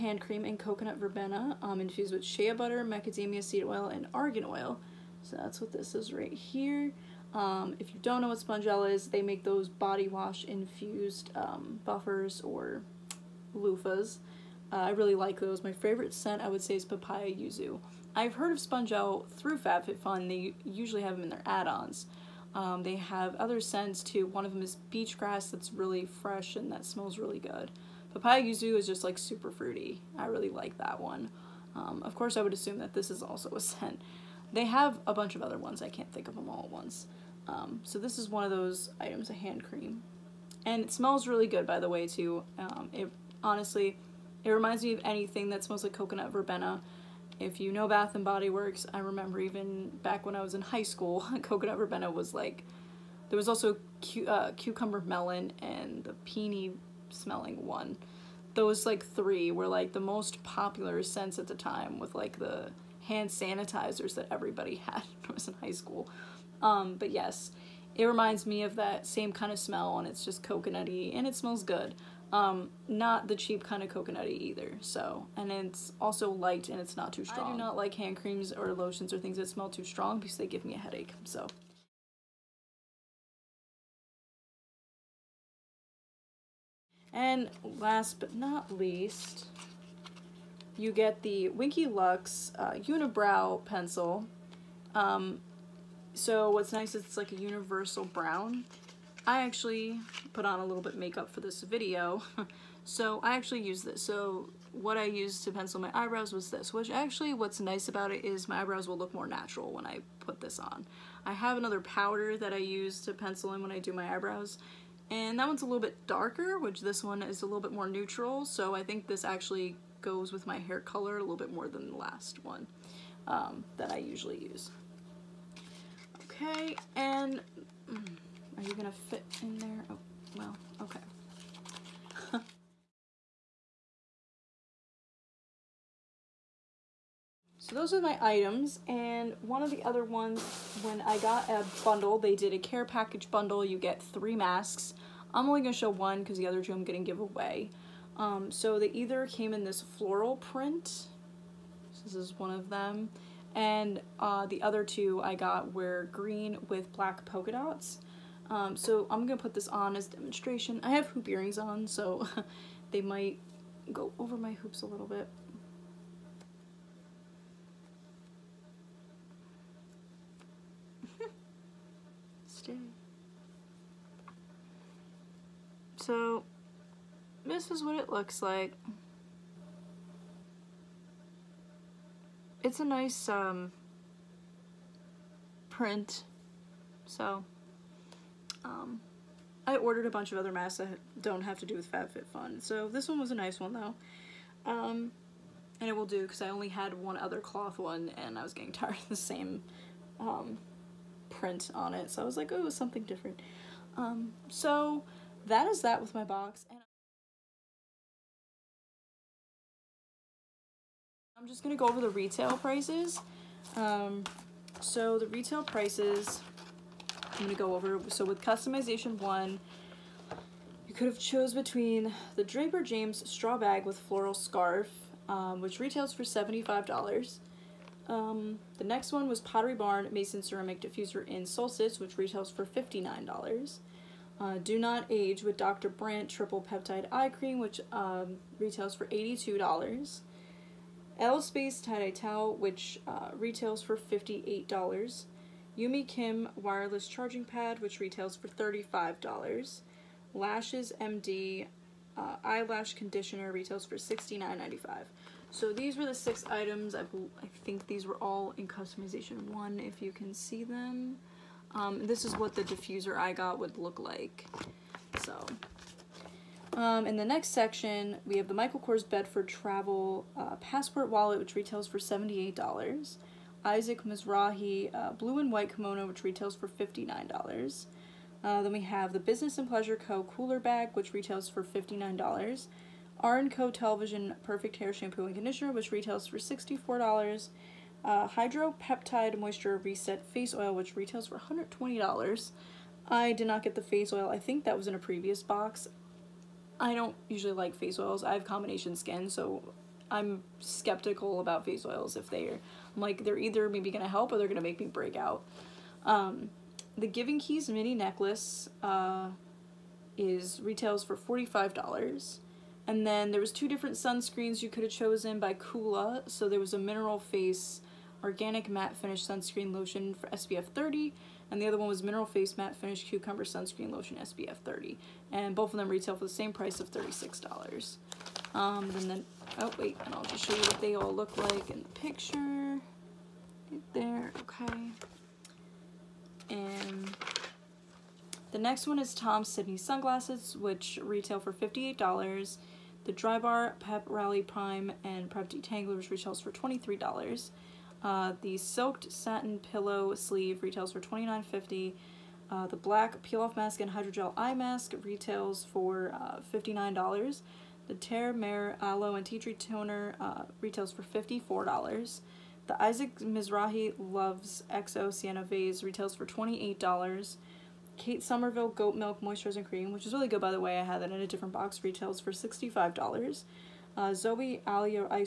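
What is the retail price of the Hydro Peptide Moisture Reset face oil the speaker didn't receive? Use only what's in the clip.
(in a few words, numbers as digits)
$120.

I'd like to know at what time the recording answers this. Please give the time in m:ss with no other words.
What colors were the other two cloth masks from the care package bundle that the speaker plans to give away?
2:36.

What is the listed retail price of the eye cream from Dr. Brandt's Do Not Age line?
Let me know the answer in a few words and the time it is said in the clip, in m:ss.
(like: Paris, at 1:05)
$82, at 3:59.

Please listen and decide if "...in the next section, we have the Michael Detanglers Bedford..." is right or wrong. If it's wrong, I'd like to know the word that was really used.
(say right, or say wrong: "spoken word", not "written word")
wrong: "Kors", not "Detanglers".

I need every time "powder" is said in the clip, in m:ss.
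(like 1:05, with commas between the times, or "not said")
1:51.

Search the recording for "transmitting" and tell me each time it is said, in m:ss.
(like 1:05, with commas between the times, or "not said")
not said.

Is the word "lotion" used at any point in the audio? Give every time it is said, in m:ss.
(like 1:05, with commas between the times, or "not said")
1:18, 5:19, 5:23.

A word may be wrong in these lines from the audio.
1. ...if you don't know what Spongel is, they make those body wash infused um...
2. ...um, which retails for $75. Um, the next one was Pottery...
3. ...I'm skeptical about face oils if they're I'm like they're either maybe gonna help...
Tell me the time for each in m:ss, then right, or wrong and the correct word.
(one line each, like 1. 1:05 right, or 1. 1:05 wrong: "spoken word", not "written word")
1. 0:07 right
2. 3:45 right
3. 5:00 right.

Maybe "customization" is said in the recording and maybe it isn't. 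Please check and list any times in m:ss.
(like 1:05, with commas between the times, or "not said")
3:38, 4:18.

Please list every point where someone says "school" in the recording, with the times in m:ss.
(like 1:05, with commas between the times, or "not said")
0:50, 1:05.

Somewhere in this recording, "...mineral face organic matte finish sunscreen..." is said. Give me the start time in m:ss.
5:16.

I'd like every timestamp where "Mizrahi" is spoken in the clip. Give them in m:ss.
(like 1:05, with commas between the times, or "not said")
4:34, 6:03.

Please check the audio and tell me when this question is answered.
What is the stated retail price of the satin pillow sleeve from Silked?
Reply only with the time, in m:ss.
5:51.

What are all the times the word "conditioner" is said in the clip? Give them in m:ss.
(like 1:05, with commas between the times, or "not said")
4:12, 4:45.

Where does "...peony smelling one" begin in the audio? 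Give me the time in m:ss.
0:56.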